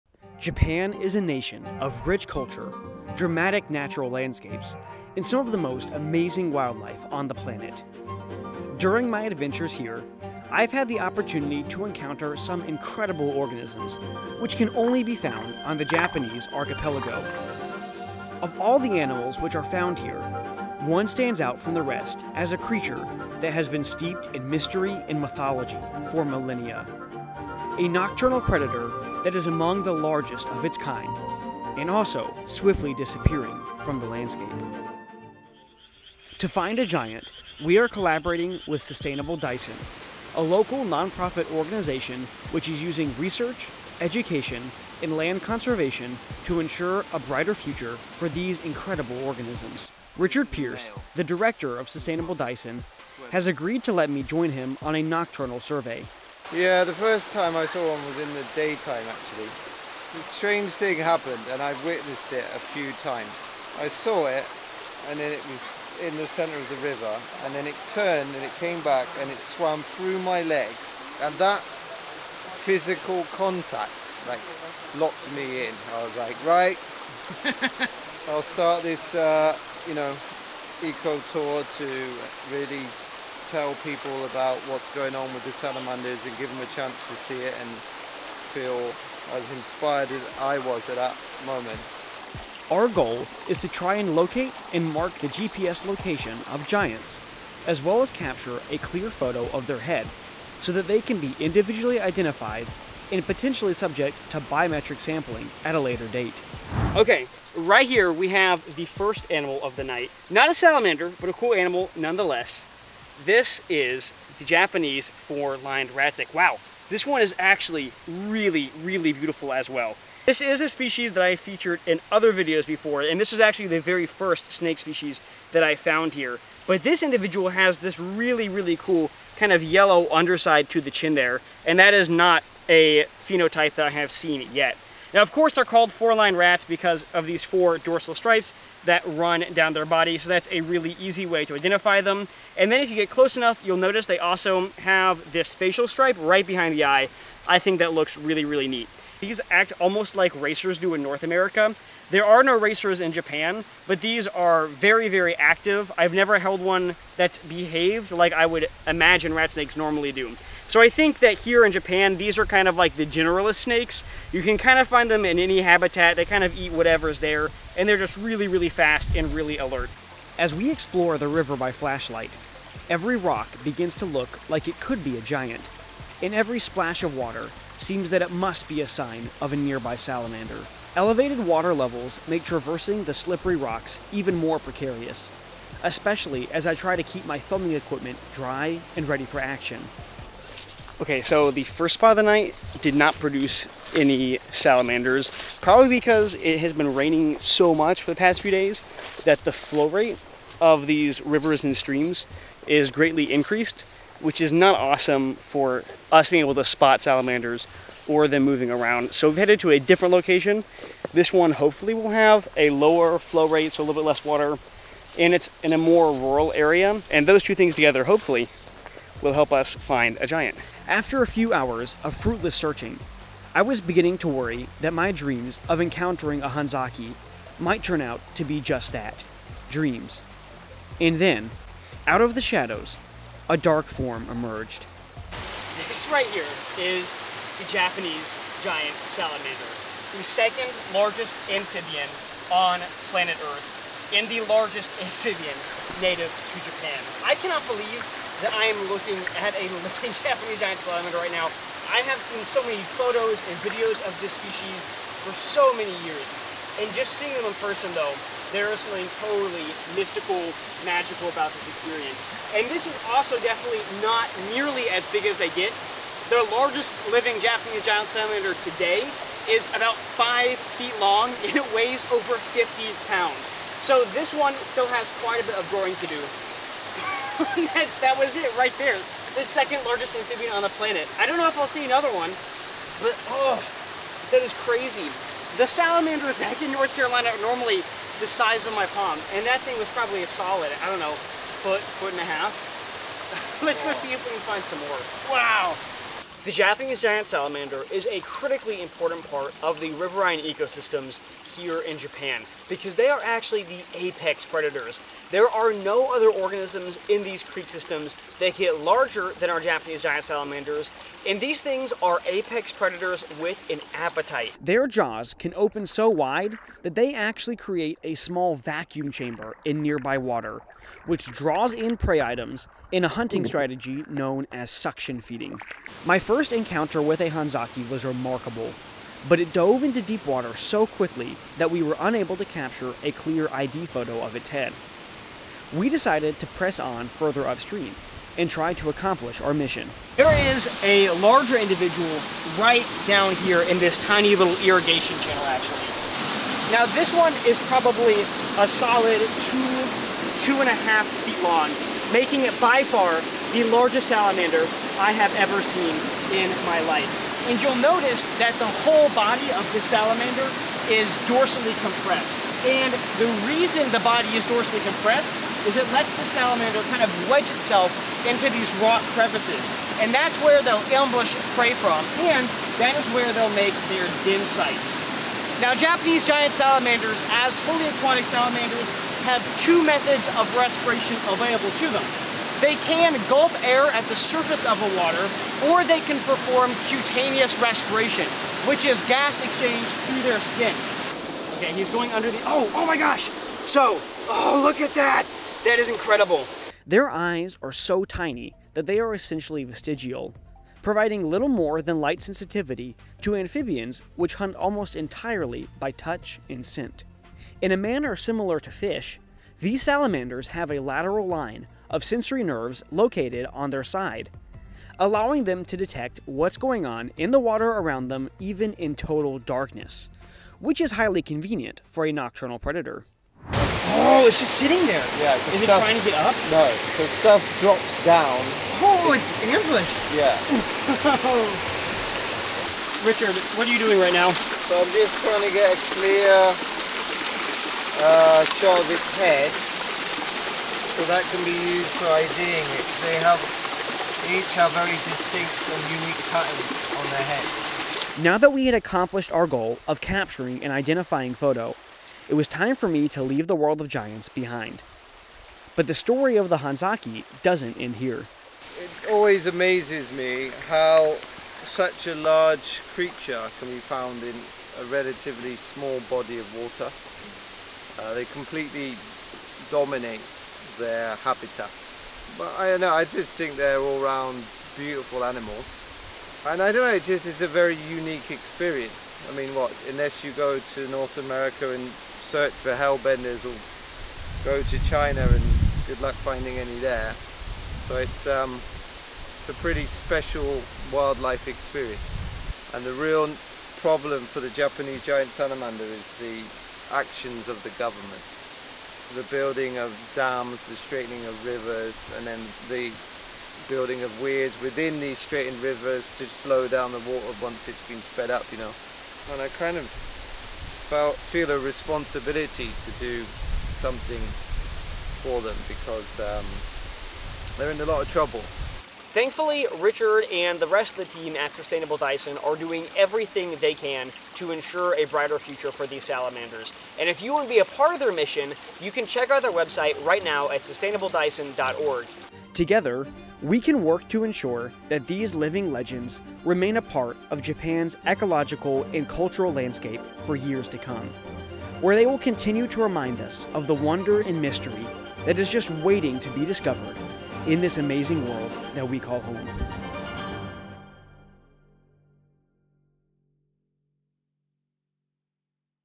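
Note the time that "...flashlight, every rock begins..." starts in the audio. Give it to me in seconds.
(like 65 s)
171 s.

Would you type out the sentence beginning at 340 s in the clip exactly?
There is a larger individual right down here in this tiny little irrigation channel actually.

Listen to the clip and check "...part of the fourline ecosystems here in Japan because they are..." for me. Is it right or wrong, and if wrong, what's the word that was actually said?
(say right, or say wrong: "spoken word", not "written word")
wrong: "riverine", not "fourline".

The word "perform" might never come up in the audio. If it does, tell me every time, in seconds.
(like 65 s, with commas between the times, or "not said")
386 s.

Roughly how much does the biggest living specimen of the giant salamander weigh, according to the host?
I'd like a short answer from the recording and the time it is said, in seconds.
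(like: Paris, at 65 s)
over 50 pounds, at 272 s.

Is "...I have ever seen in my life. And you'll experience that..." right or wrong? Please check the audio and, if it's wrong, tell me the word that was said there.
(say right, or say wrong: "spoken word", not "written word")
wrong: "notice", not "experience".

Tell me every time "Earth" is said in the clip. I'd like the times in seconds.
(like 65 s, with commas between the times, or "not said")
243 s.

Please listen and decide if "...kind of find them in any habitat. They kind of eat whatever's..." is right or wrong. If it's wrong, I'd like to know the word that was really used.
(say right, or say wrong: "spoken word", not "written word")
right.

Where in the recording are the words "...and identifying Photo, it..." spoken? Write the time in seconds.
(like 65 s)
450 s.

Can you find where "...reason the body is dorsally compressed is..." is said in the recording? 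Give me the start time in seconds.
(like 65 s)
363 s.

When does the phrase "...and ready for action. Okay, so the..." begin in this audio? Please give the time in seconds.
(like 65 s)
188 s.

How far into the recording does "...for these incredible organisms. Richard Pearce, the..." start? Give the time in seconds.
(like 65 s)
48 s.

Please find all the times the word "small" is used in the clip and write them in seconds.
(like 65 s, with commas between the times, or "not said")
318 s, 465 s.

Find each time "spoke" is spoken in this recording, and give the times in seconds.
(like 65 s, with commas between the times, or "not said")
not said.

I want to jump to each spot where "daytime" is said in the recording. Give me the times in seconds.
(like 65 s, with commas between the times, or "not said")
58 s.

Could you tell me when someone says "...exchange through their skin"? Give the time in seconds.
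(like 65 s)
389 s.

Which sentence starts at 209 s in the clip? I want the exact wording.
So we've headed to a different location.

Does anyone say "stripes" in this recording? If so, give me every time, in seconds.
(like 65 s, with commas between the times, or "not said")
138 s, 145 s.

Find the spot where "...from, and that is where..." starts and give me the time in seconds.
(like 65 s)
371 s.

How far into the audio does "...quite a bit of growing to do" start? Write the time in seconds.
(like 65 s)
275 s.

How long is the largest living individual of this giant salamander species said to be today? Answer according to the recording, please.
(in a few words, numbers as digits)
5 feet.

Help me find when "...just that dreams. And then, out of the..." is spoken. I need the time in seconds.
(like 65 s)
228 s.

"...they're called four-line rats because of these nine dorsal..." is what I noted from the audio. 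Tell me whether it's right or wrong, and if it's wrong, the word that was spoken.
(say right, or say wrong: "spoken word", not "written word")
wrong: "four", not "nine".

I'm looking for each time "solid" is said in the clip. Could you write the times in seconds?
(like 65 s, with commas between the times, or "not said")
290 s, 348 s.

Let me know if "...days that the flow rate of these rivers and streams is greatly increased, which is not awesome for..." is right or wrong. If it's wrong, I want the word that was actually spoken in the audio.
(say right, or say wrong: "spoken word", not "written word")
right.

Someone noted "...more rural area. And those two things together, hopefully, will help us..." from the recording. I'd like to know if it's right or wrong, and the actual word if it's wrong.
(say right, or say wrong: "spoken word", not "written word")
right.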